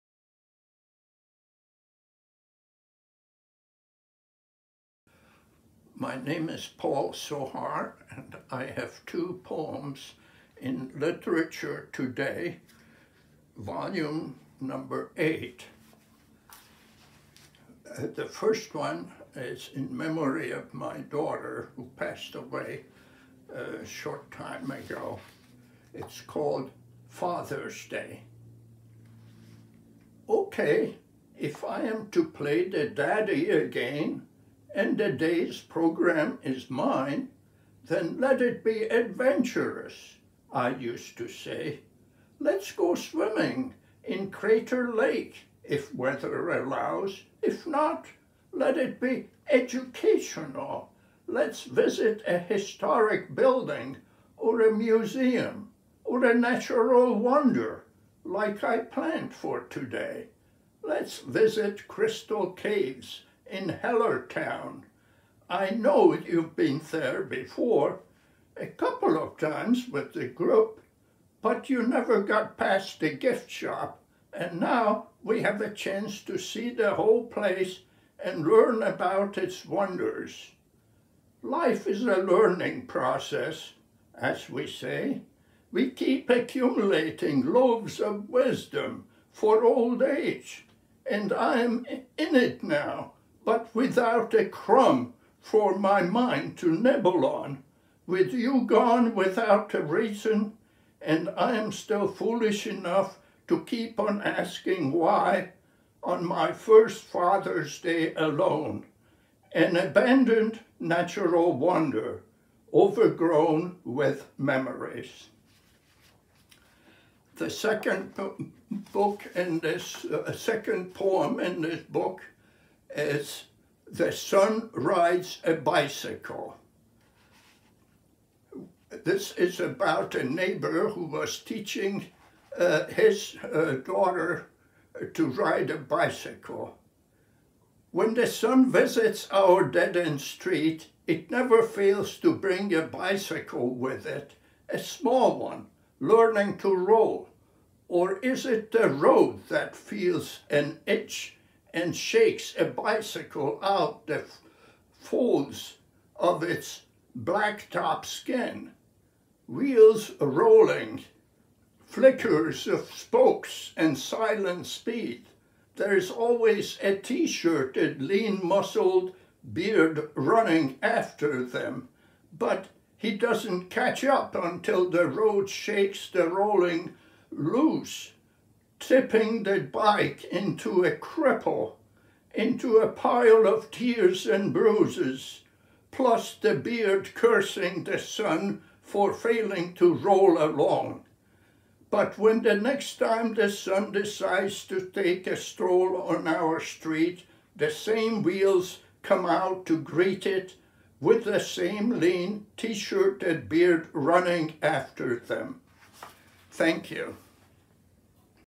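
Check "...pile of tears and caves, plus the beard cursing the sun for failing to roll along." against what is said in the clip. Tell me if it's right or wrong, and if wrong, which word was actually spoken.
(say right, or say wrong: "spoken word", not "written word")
wrong: "bruises", not "caves".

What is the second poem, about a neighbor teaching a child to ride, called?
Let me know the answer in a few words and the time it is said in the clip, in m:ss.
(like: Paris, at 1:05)
The Sun Rides a Bicycle, at 2:03.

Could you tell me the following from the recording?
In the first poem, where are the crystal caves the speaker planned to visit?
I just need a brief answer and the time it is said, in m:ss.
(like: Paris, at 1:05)
Hellertown, at 1:03.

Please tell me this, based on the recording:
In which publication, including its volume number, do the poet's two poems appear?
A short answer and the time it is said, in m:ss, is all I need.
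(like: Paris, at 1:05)
Literature Today, volume 8, at 0:10.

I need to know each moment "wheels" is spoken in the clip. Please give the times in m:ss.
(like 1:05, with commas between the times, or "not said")
2:39, 3:18.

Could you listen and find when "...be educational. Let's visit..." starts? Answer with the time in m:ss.
0:49.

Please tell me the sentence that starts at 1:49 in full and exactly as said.
An abandoned natural wonder, overgrown with memories.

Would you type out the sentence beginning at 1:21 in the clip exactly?
Life is a learning process, as we say.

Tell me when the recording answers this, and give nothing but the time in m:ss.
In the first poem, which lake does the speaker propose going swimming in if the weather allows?
0:44.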